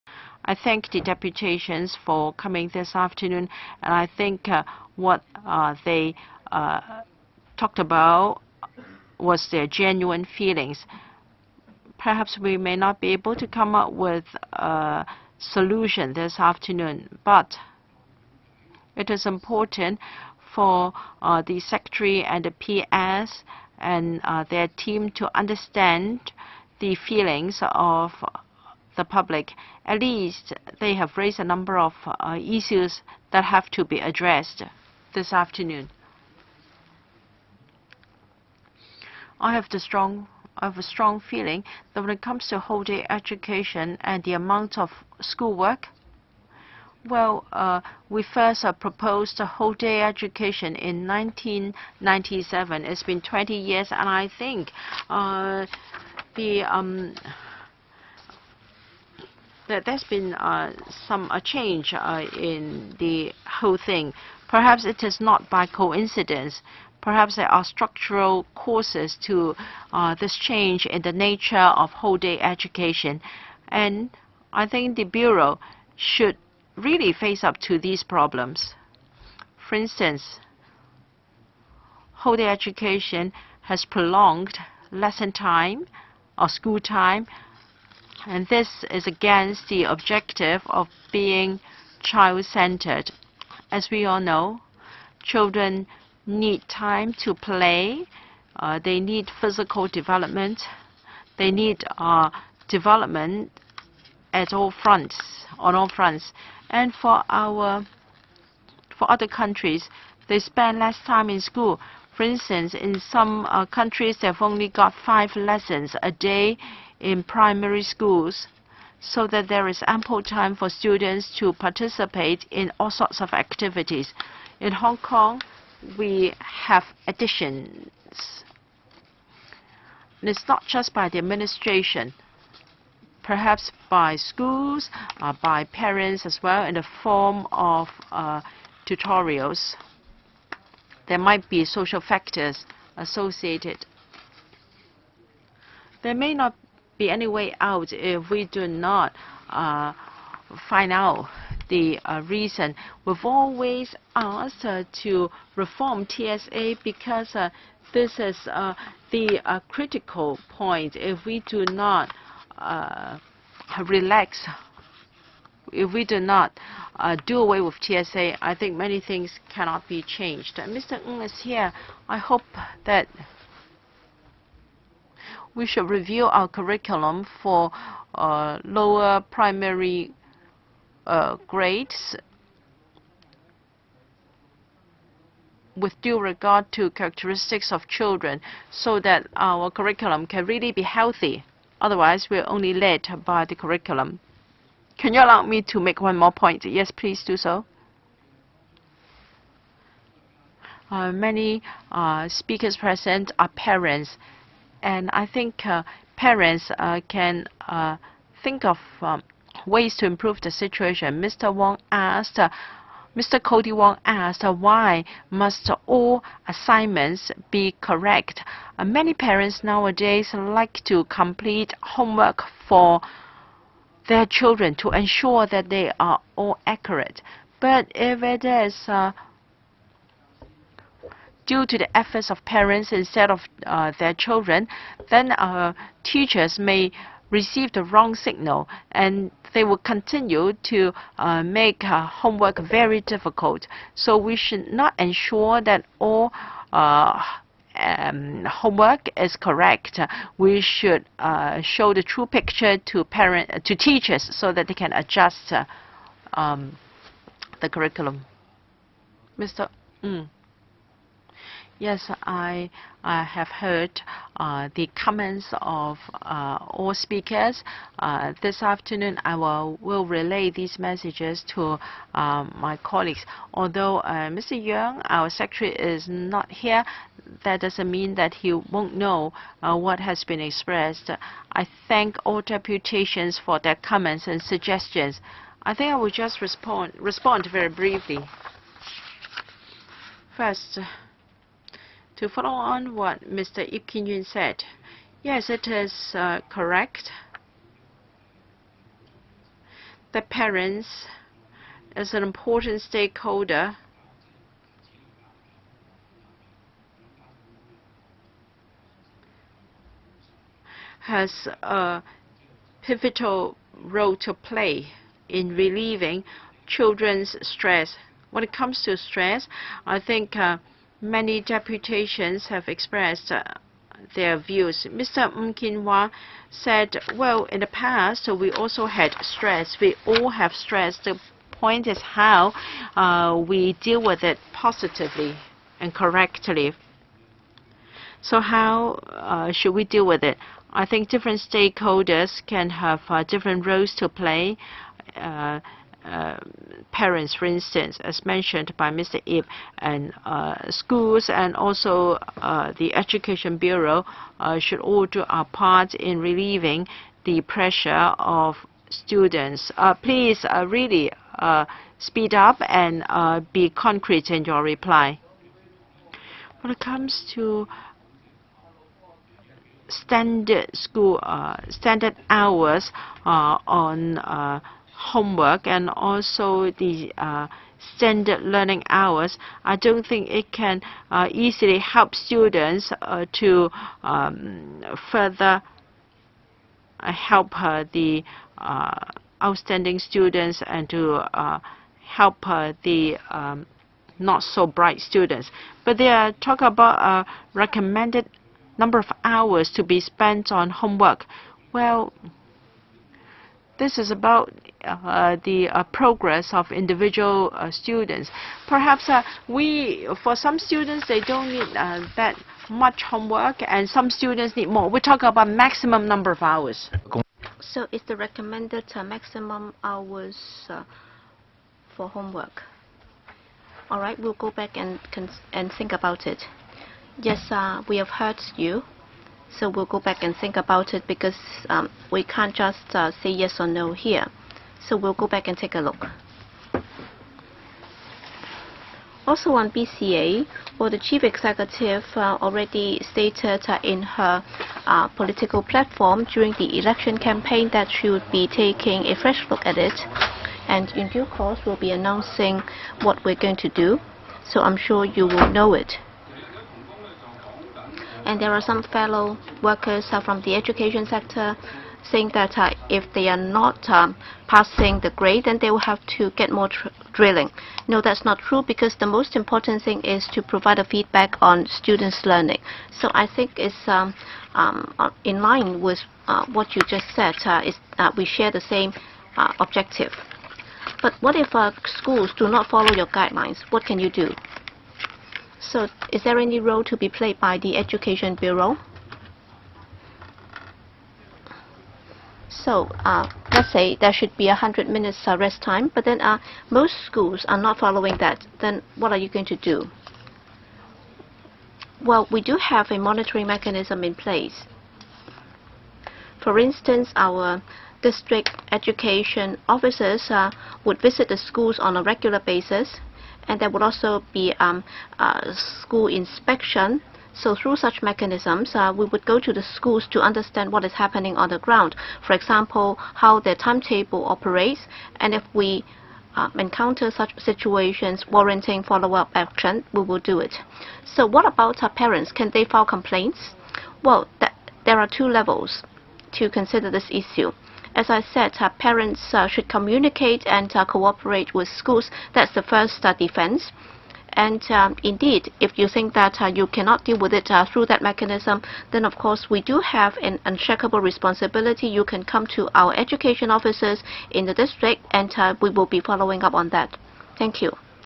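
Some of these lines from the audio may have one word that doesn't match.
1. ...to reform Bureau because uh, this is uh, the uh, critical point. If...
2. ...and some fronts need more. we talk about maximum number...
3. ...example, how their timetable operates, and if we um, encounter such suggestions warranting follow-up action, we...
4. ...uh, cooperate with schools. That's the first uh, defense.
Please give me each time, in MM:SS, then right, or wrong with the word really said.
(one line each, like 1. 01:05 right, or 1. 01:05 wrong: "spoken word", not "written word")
1. 02:35 wrong: "TSA", not "Bureau"
2. 06:53 wrong: "students", not "fronts"
3. 08:42 wrong: "situations", not "suggestions"
4. 09:00 right.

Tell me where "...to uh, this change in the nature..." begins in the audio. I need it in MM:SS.
01:09.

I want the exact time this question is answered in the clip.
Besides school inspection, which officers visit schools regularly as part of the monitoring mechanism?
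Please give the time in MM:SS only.
08:28.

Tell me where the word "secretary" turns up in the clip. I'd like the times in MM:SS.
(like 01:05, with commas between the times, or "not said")
00:21, 04:35.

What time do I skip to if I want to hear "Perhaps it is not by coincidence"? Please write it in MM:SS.
01:04.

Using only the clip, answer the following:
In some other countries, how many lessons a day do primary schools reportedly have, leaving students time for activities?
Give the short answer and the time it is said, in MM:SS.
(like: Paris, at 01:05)
5, at 01:55.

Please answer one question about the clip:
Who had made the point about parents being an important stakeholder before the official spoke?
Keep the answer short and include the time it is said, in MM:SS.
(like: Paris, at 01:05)
Ip Kin Yuen, at 04:53.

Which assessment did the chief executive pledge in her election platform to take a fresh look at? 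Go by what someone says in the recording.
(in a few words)
BCA.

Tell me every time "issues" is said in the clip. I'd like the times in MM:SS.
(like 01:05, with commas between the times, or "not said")
00:32, 08:57.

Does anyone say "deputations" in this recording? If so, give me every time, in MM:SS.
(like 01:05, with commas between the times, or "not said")
00:00, 04:42, 05:21.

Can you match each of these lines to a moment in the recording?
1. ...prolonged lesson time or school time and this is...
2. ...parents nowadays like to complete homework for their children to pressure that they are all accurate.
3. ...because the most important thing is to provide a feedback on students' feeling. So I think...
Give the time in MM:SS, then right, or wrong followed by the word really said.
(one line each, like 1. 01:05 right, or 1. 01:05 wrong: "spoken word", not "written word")
1. 01:23 right
2. 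03:39 wrong: "ensure", not "pressure"
3. 07:48 wrong: "learning", not "feeling".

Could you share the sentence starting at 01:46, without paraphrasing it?
And for our, for other countries, they spend less time in school.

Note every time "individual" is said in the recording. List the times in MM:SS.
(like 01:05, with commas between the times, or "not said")
06:46.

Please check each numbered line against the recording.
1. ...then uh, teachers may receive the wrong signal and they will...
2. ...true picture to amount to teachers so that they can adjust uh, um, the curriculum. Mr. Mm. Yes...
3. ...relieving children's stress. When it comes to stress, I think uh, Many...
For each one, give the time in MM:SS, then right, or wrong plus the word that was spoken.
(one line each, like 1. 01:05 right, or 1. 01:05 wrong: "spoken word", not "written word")
1. 03:55 right
2. 04:12 wrong: "parent", not "amount"
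3. 05:15 right.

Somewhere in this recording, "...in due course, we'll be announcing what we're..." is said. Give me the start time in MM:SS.
07:30.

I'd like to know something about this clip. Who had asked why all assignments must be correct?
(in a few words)
Cody Wong.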